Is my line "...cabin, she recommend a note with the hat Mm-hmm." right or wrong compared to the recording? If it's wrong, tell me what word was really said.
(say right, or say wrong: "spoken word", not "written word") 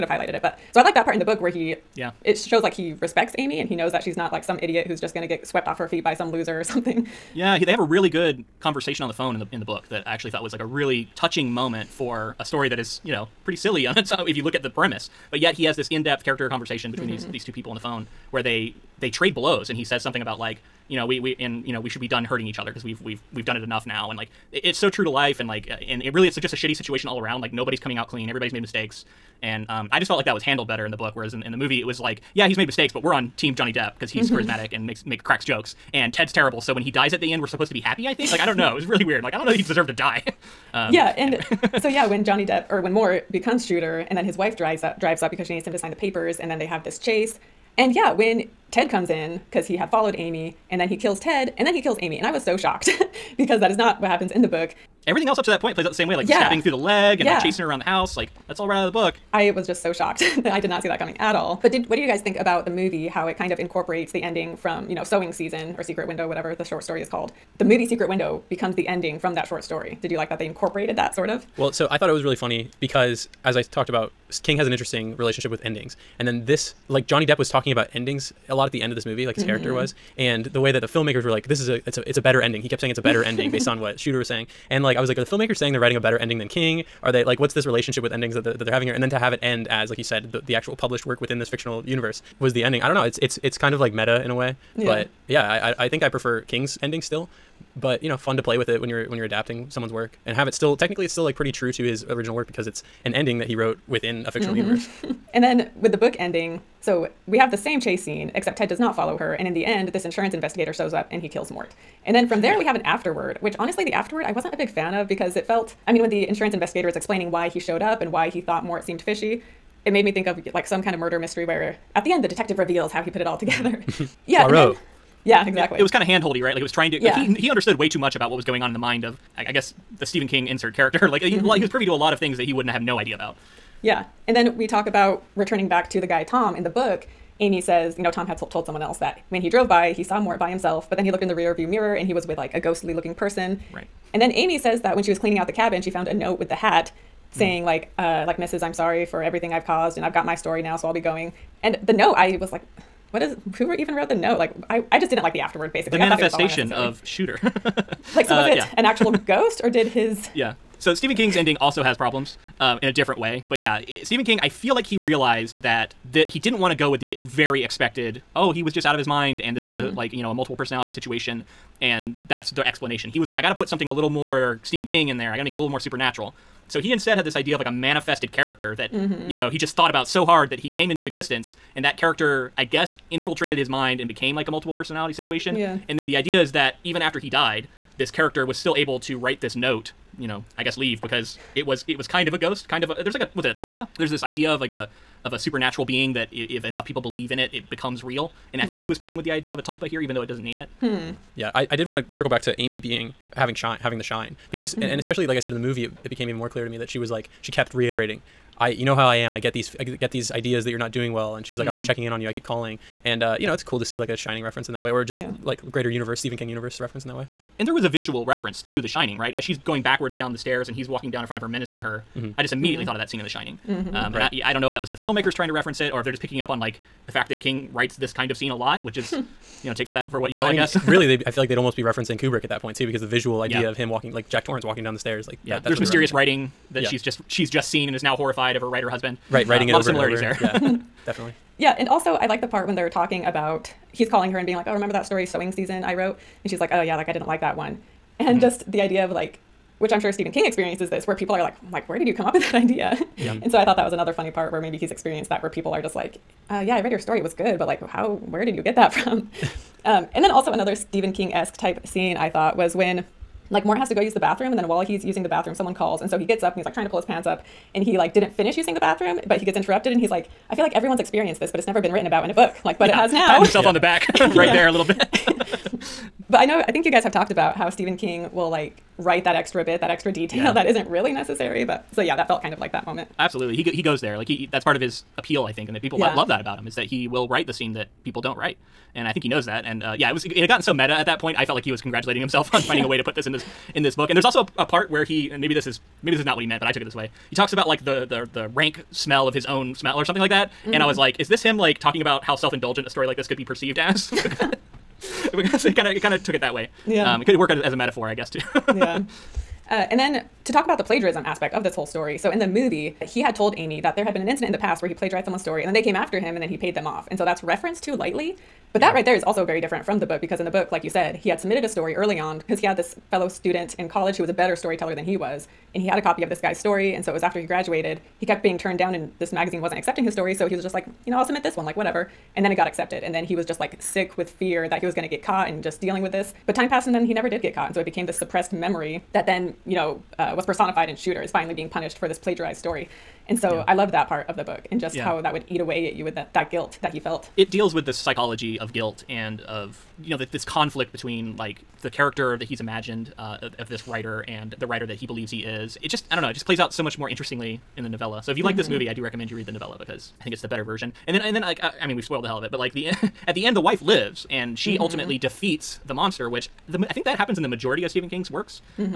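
wrong: "found", not "recommend".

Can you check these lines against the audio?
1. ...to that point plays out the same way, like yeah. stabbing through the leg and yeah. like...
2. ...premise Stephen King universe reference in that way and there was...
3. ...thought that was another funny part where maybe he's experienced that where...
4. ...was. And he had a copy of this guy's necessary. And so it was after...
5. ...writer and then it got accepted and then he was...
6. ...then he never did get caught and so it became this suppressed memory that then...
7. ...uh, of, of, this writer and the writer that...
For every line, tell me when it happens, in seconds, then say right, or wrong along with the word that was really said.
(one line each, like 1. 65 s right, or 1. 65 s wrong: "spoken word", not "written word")
1. 55 s right
2. 215 s wrong: "universe", not "premise"
3. 253 s right
4. 325 s wrong: "story", not "necessary"
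5. 331 s wrong: "whatever", not "writer"
6. 336 s right
7. 353 s right.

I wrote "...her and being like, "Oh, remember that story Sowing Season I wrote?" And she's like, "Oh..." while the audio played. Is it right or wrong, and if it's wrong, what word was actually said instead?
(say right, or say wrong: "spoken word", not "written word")
right.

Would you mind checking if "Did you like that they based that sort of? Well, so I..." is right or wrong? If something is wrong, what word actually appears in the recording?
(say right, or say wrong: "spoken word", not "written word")
wrong: "incorporated", not "based".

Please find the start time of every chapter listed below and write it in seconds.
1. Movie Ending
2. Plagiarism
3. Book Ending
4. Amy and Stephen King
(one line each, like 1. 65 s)
1. 40 s
2. 308 s
3. 104 s
4. 200 s.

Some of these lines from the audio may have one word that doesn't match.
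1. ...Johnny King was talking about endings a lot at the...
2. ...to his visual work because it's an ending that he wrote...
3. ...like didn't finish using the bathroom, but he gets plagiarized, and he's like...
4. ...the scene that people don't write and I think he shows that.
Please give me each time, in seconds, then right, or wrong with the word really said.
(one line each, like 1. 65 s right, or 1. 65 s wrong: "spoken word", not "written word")
1. 77 s wrong: "Depp", not "King"
2. 101 s wrong: "original", not "visual"
3. 267 s wrong: "interrupted", not "plagiarized"
4. 287 s wrong: "knows", not "shows".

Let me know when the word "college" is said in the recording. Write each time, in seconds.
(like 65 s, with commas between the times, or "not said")
323 s.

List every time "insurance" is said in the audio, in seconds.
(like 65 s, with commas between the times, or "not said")
110 s, 116 s.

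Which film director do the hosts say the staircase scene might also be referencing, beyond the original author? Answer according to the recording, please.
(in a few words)
Kubrick.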